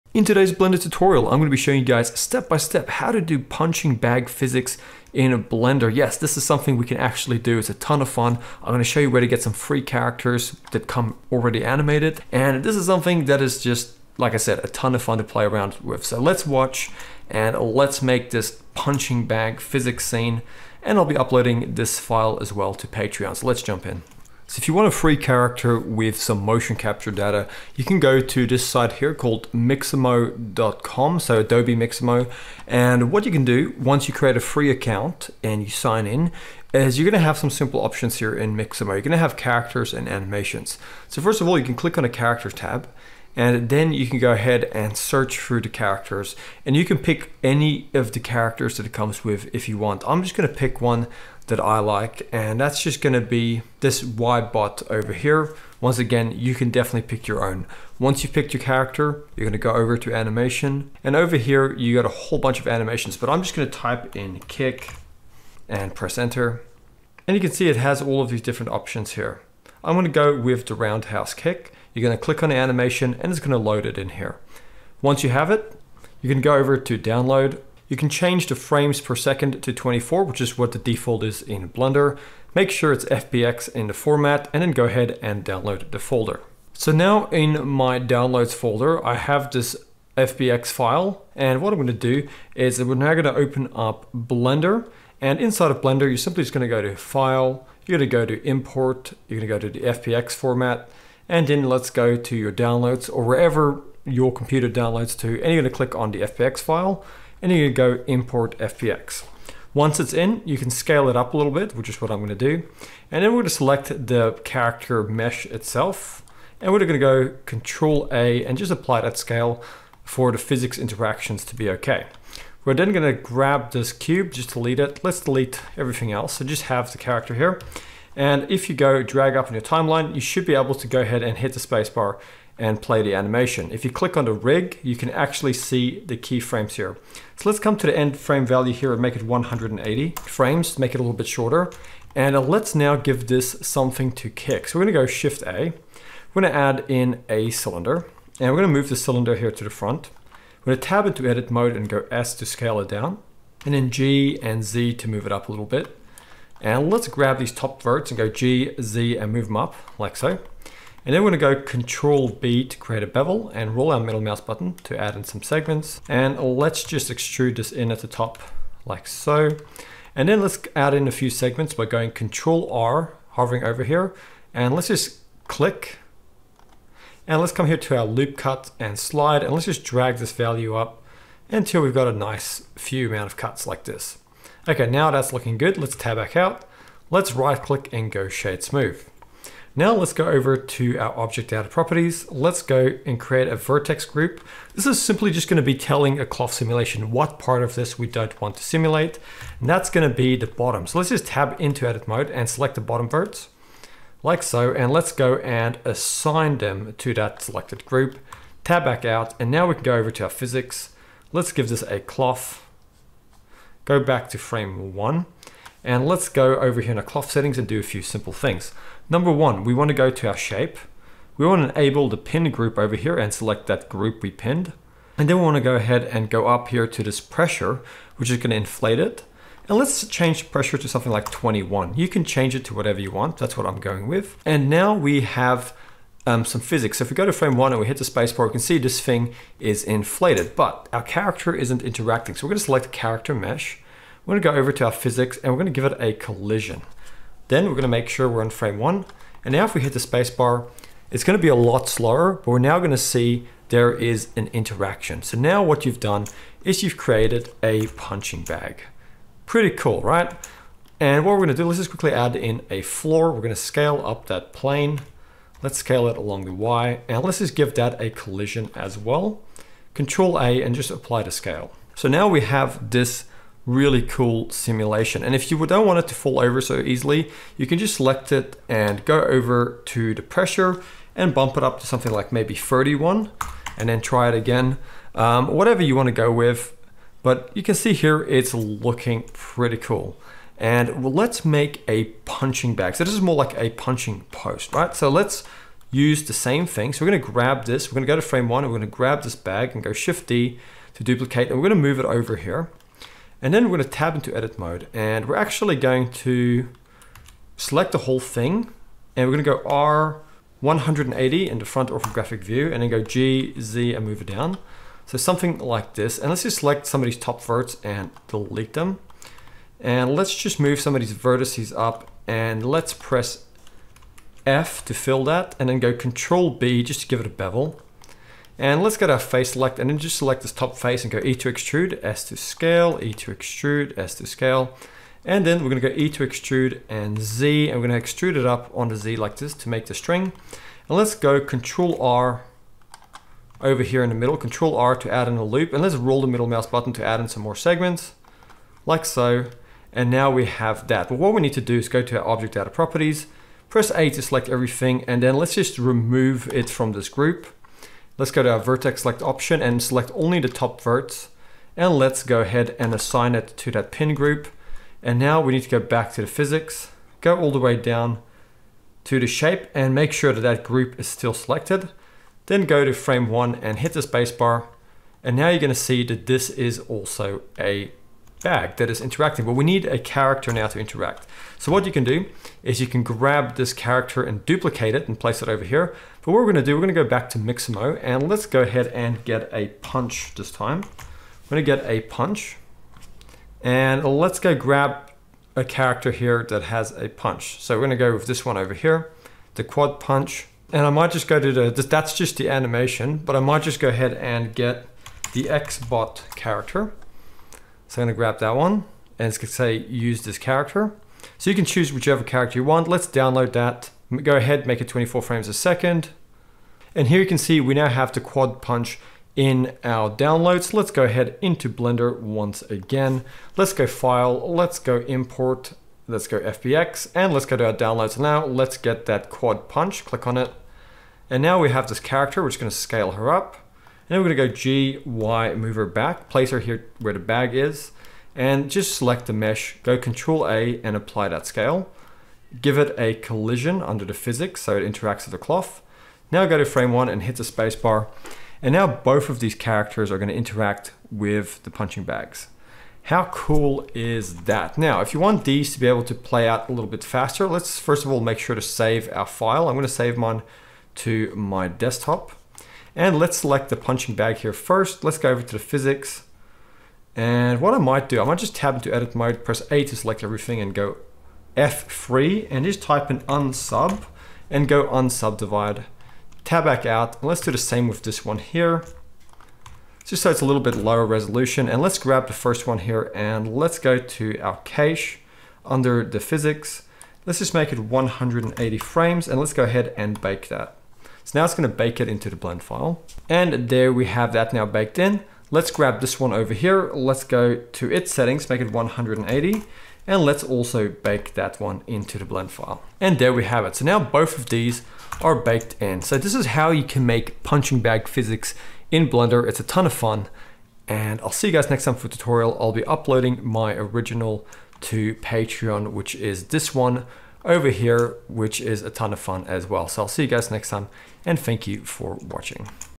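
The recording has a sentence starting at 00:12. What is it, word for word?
And this is something that is just, like I said, a ton of fun to play around with.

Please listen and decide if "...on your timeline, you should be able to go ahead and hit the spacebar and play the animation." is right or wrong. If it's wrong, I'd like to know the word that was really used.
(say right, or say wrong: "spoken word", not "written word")
right.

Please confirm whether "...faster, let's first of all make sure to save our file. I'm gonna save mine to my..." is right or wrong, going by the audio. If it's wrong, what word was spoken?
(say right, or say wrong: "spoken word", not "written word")
right.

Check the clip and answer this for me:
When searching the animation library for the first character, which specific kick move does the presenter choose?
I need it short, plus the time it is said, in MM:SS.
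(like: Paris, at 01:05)
Roundhouse kick, at 01:10.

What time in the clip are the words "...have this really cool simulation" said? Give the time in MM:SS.
04:32.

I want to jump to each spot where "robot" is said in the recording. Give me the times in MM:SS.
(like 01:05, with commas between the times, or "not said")
not said.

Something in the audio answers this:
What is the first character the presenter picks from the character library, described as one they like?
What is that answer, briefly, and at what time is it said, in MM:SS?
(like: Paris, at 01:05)
Y bot, at 00:54.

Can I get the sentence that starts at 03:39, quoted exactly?
Number one, we want to go to our shape.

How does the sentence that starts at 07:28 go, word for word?
And now both of these characters are gonna interact with the punching bags.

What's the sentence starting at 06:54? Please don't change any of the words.
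Go ahead, make it 24 frames a second.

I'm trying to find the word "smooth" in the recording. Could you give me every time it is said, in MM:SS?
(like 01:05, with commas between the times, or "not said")
03:08.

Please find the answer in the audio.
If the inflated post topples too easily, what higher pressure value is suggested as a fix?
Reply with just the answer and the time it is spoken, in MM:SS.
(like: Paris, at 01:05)
31, at 04:42.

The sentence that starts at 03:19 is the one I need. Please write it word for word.
And that's gonna be the bottom.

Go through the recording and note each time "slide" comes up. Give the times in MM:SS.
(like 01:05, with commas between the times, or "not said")
02:58.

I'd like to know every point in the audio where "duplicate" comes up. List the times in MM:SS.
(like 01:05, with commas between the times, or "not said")
05:01, 06:24.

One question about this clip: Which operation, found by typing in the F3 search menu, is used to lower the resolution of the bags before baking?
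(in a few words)
Unsubdivide.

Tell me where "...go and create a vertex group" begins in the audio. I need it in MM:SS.
03:12.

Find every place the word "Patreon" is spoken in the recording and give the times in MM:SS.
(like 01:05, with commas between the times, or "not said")
00:22, 08:35.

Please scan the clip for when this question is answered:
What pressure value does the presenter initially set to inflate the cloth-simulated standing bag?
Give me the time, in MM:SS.
03:51.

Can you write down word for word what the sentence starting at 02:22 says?
And uh, let's now give this something to kick.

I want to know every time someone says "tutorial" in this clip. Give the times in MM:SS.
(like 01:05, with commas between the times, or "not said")
00:00, 08:32.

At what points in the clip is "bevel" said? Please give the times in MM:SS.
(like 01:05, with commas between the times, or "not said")
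02:43, 05:27.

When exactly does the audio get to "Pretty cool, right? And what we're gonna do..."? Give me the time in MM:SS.
04:19.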